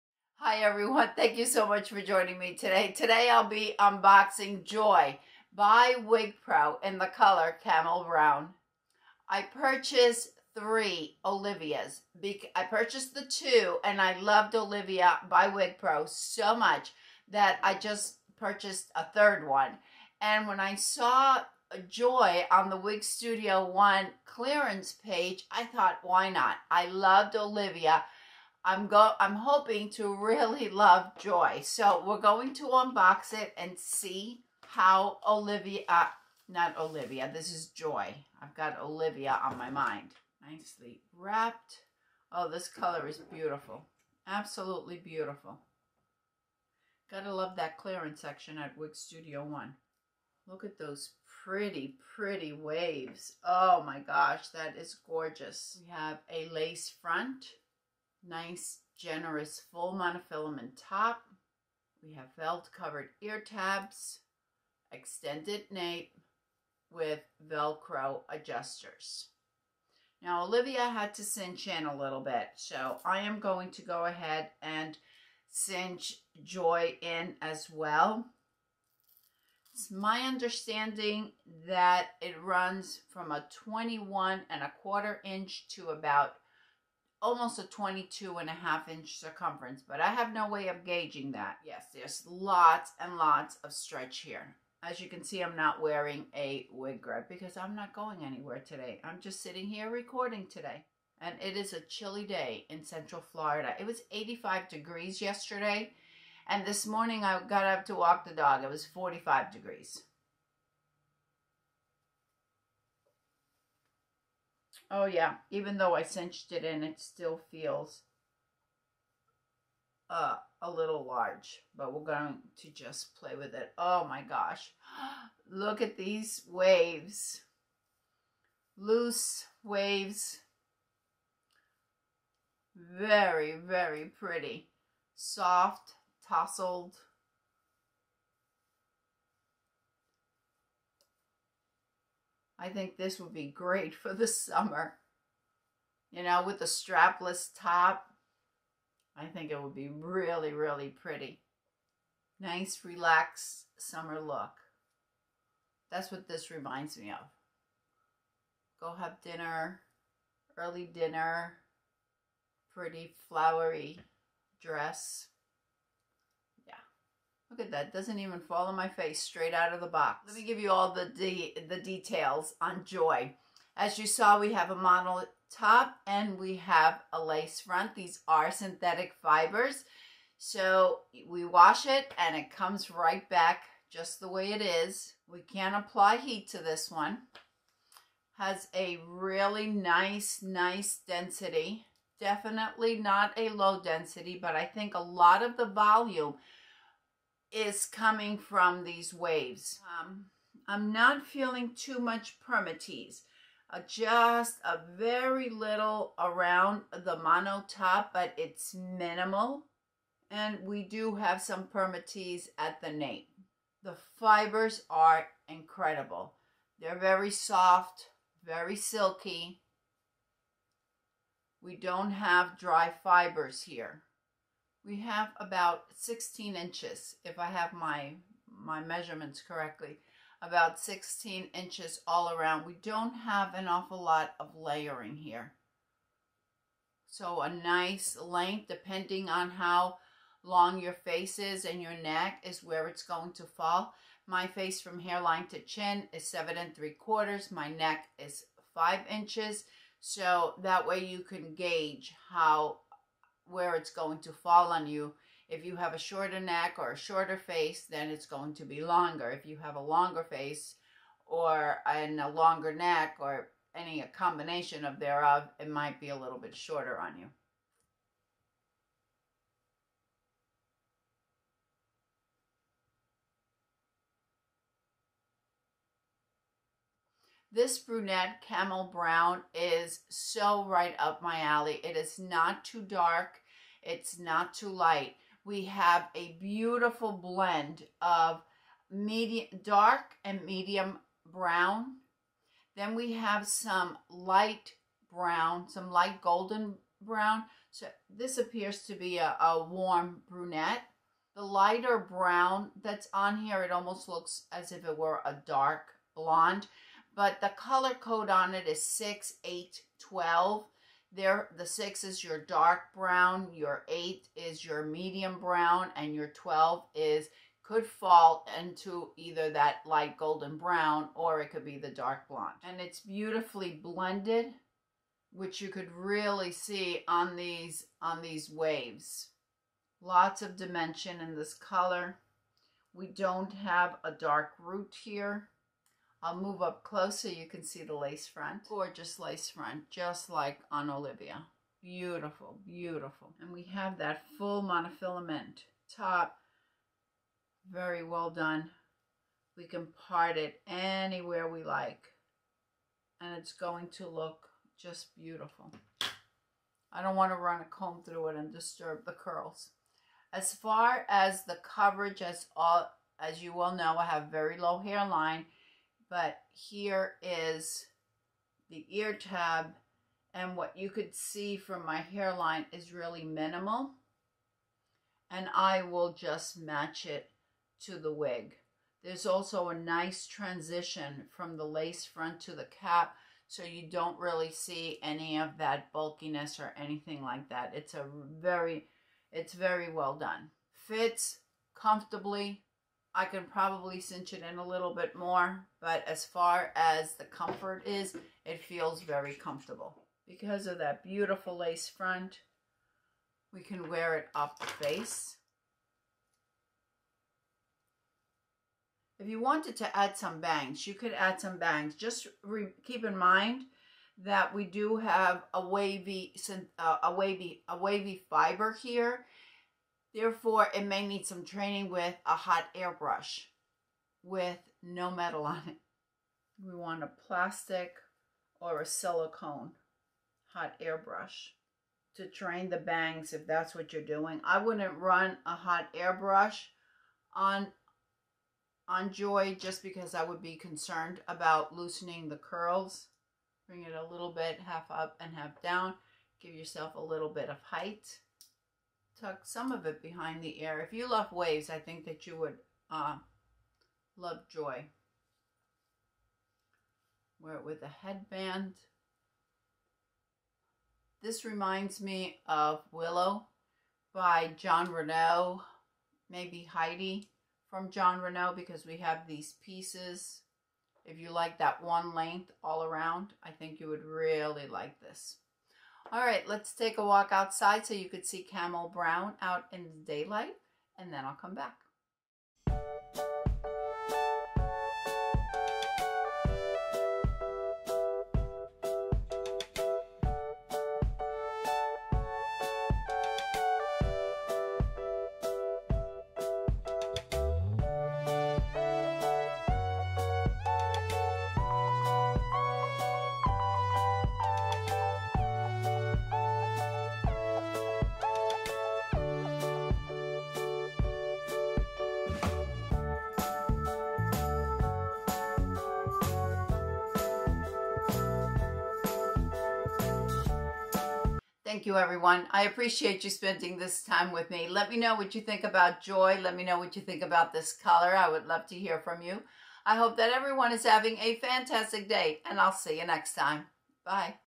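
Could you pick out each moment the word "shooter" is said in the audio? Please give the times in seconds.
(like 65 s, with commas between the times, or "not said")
not said.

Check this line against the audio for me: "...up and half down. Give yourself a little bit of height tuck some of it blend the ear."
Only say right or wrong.
wrong.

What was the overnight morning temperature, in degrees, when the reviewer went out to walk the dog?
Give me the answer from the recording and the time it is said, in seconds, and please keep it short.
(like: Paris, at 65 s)
45, at 108 s.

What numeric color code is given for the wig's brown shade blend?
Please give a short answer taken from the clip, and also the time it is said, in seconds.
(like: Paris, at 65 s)
6, 8, 12, at 308 s.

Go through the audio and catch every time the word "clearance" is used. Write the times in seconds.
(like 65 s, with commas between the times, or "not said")
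24 s, 47 s.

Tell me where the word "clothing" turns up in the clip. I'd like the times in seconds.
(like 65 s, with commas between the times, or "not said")
not said.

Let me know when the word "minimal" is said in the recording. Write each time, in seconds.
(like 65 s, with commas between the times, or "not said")
208 s, 373 s.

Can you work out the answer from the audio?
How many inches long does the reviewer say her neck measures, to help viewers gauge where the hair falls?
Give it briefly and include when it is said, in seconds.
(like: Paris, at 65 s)
5, at 248 s.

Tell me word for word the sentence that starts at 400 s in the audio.
Because of that beautiful lace front, we can wear it off the face.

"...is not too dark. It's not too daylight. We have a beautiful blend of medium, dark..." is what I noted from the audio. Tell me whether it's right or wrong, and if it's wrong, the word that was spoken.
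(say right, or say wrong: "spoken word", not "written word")
wrong: "light", not "daylight".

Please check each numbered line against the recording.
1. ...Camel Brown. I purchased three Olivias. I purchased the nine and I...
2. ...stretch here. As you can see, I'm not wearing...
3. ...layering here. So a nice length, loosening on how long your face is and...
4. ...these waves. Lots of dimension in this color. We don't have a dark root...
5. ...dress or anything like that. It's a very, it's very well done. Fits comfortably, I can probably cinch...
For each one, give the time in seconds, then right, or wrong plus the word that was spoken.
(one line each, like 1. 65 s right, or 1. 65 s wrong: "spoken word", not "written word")
1. 7 s wrong: "two", not "nine"
2. 93 s right
3. 234 s wrong: "depending", not "loosening"
4. 328 s right
5. 385 s wrong: "bulkiness", not "dress".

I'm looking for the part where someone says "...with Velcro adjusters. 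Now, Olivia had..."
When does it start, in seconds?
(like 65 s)
66 s.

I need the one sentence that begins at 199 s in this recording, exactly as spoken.
Um, I'm not feeling too much permatease.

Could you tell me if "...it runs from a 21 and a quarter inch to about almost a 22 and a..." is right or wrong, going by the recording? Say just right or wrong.
right.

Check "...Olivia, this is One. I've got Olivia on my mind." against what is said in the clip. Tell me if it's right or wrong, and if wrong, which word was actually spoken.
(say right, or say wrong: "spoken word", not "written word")
wrong: "Joy", not "One".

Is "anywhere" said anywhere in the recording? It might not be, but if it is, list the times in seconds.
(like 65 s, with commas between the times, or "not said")
98 s, 350 s.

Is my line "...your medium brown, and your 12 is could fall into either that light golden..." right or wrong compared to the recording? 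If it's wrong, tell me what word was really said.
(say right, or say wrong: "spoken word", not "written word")
right.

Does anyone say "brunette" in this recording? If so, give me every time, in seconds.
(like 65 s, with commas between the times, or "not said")
277 s, 300 s.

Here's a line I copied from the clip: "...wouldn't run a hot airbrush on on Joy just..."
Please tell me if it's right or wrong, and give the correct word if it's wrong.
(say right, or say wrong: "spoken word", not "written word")
right.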